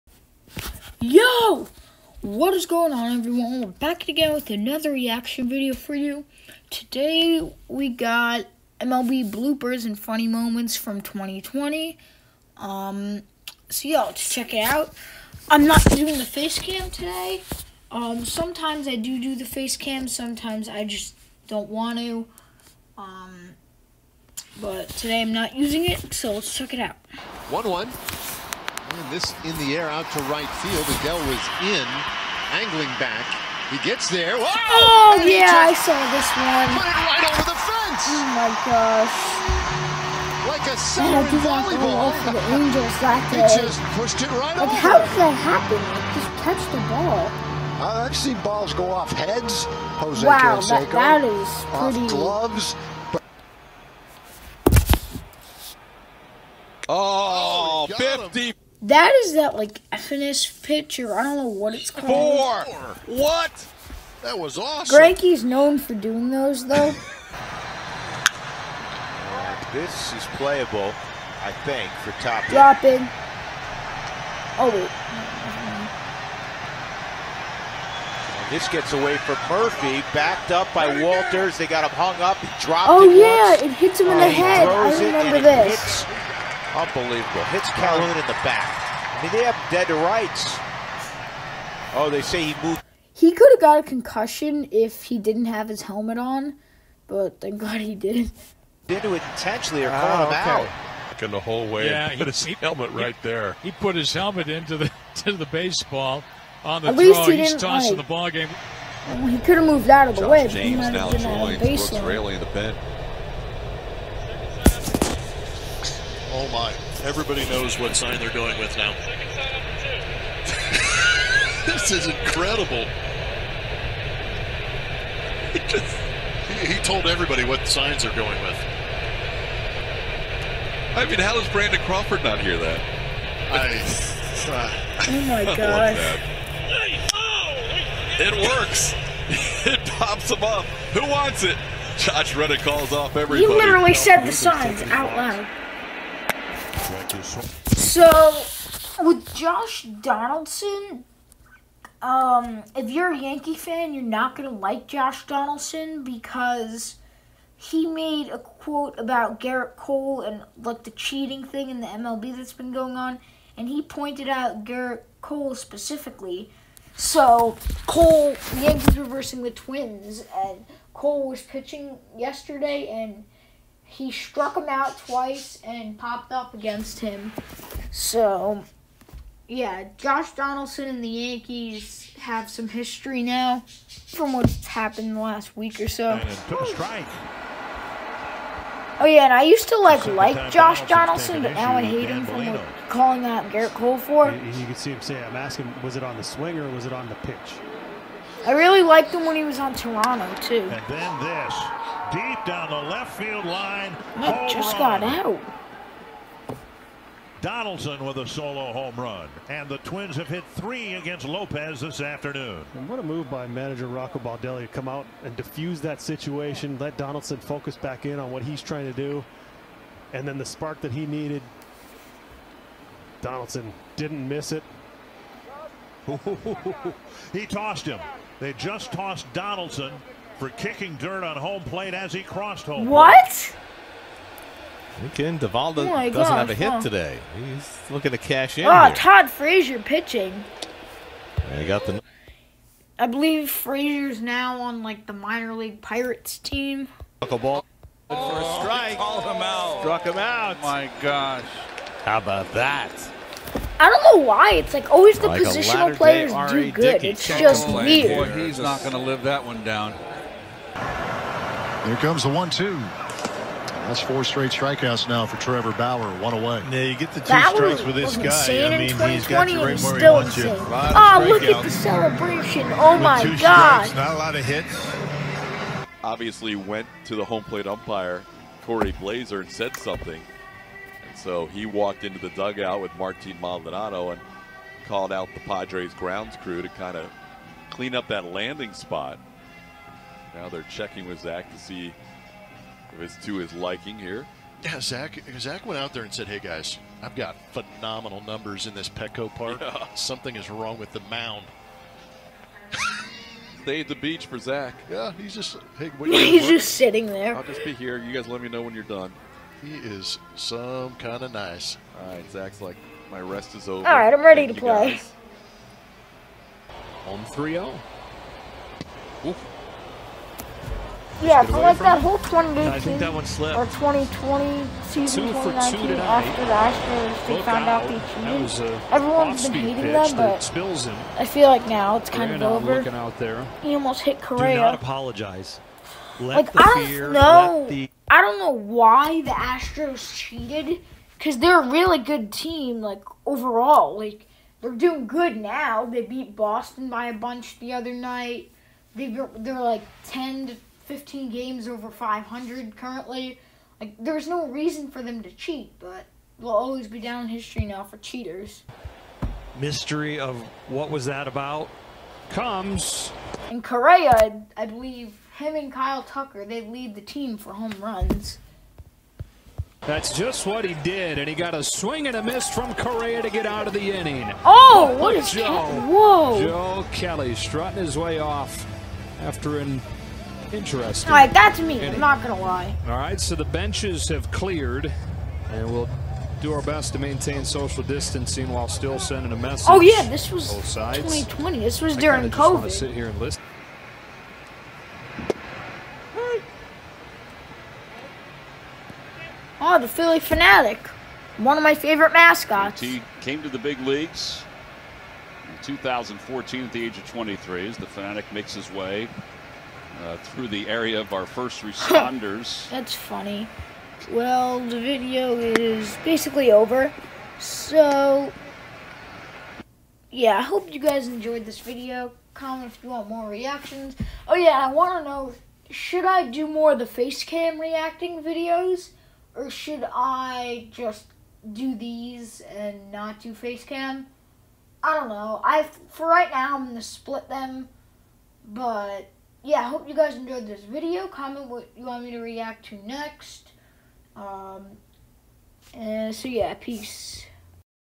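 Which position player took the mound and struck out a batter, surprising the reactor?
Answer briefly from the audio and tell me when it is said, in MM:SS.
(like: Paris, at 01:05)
Todd Frazier, at 03:58.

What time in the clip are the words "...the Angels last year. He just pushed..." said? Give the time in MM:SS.
00:42.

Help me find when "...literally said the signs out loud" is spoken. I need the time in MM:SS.
02:23.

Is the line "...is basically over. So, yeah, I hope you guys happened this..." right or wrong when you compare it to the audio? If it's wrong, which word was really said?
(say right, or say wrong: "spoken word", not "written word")
wrong: "enjoyed", not "happened".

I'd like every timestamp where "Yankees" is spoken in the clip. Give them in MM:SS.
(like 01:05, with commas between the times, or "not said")
02:33, 02:48, 03:01.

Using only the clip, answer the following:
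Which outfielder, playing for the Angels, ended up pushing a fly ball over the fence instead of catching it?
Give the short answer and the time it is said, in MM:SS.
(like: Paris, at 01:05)
Adell, at 00:30.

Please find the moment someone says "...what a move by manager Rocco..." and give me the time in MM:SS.
03:32.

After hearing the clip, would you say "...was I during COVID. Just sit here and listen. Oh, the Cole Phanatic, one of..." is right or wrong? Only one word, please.
wrong.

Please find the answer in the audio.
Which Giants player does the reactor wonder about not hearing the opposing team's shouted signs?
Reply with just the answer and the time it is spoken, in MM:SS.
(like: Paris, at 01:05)
Brandon Crawford, at 02:11.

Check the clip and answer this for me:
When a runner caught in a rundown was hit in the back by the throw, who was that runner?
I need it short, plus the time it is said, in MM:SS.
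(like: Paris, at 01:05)
Calhoun, at 01:27.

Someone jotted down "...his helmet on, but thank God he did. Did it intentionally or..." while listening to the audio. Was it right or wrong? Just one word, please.
right.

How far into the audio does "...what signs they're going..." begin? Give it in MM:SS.
02:07.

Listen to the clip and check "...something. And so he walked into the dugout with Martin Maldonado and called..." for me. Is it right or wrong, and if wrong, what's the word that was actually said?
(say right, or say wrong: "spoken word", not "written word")
right.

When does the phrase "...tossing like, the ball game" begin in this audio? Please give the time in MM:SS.
01:47.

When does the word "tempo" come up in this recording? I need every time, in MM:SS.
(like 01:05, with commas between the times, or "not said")
not said.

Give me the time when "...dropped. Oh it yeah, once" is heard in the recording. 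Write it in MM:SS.
01:22.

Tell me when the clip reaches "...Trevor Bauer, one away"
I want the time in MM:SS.
04:25.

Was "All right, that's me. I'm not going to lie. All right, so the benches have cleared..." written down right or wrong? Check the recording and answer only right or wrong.
right.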